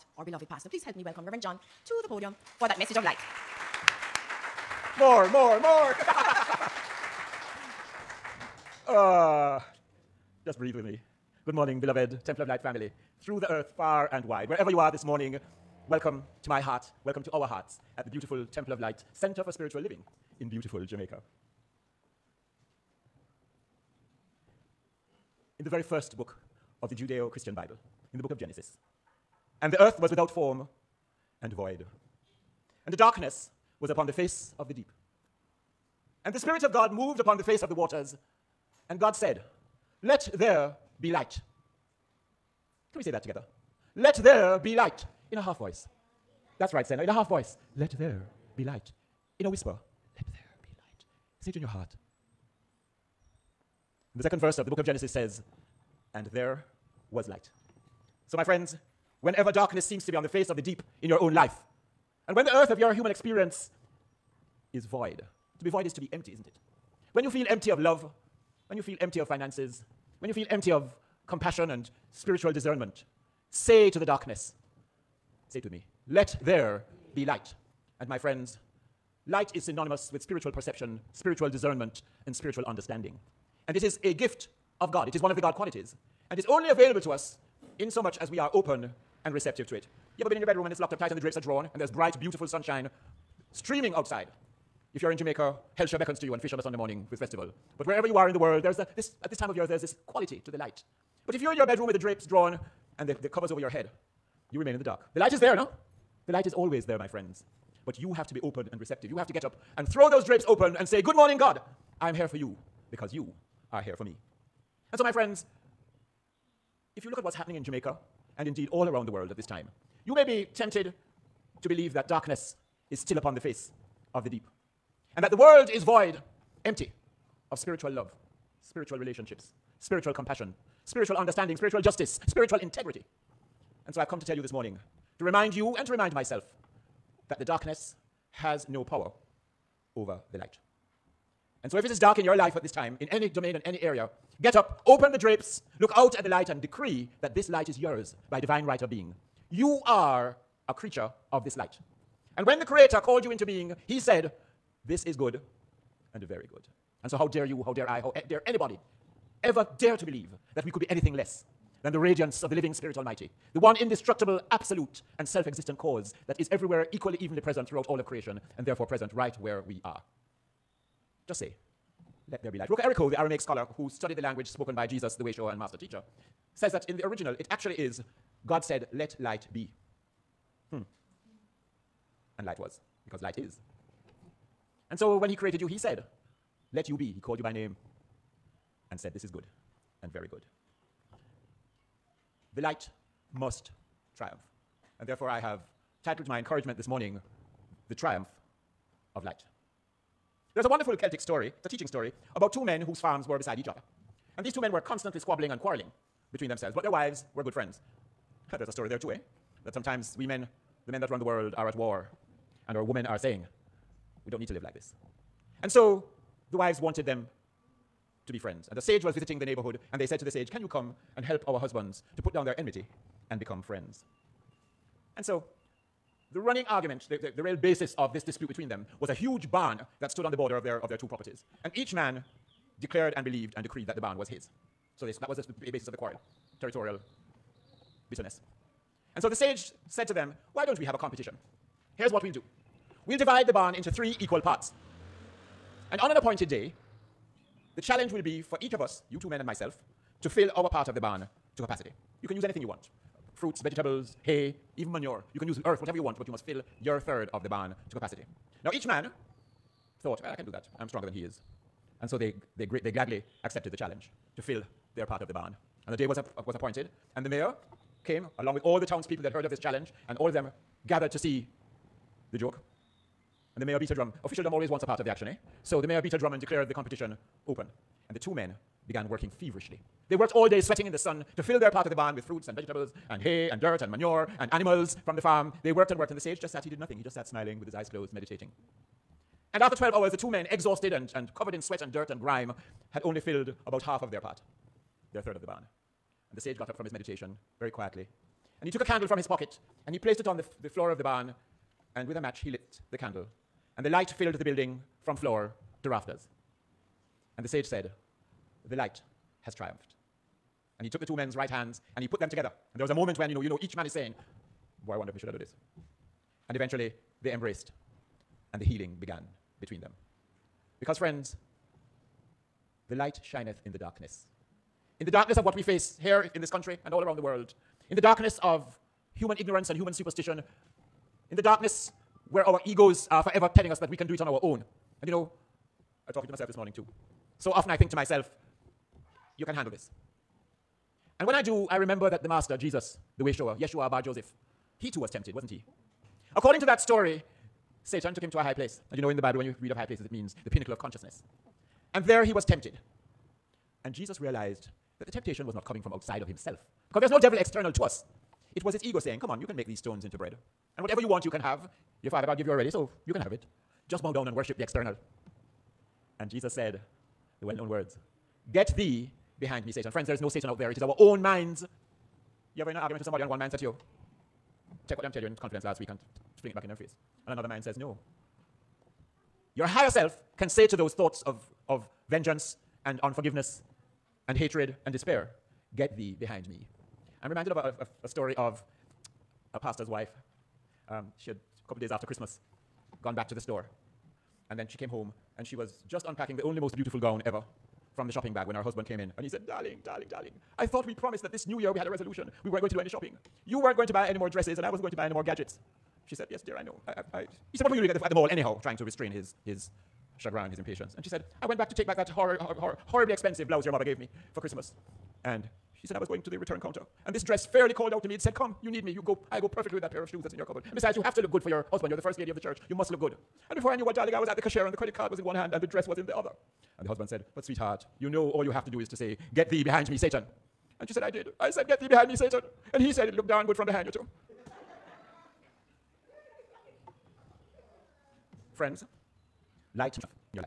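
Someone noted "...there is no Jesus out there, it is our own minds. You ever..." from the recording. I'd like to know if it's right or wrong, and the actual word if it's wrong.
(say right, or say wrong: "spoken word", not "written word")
wrong: "Satan", not "Jesus".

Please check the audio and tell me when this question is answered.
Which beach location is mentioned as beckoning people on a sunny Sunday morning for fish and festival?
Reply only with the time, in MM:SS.
01:35.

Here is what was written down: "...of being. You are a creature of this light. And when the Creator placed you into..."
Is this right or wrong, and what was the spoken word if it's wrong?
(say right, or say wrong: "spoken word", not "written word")
wrong: "called", not "placed".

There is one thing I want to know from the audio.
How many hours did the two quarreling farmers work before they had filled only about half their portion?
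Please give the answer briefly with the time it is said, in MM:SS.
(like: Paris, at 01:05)
12, at 04:49.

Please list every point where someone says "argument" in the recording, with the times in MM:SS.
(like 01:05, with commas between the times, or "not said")
03:46, 06:12.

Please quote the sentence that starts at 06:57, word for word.
And this dress fairly called out to me.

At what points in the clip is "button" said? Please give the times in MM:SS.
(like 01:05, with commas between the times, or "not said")
not said.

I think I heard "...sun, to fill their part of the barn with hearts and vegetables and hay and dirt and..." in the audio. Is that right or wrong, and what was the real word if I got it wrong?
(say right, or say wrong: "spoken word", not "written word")
wrong: "fruits", not "hearts".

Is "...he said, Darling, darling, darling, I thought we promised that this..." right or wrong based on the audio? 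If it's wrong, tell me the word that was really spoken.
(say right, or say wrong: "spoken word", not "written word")
right.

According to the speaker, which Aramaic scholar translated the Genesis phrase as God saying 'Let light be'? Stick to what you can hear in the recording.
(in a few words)
Rocco Errico.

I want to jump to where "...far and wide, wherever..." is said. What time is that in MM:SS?
00:13.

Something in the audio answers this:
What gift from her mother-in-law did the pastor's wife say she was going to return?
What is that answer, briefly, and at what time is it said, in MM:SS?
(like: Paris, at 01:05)
blouse, at 06:53.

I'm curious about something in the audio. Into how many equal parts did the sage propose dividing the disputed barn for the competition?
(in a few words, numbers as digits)
3.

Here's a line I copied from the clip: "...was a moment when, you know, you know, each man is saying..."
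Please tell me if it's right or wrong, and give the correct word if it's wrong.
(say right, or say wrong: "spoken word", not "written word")
right.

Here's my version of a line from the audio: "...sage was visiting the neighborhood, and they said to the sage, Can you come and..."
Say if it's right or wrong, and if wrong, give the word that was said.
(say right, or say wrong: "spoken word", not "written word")
right.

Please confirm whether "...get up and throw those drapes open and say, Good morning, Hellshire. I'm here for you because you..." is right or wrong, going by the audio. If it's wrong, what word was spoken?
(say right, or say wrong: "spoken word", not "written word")
wrong: "God", not "Hellshire".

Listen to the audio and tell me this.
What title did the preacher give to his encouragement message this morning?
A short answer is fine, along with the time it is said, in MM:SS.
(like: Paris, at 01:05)
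The Triumph of Light, at 03:17.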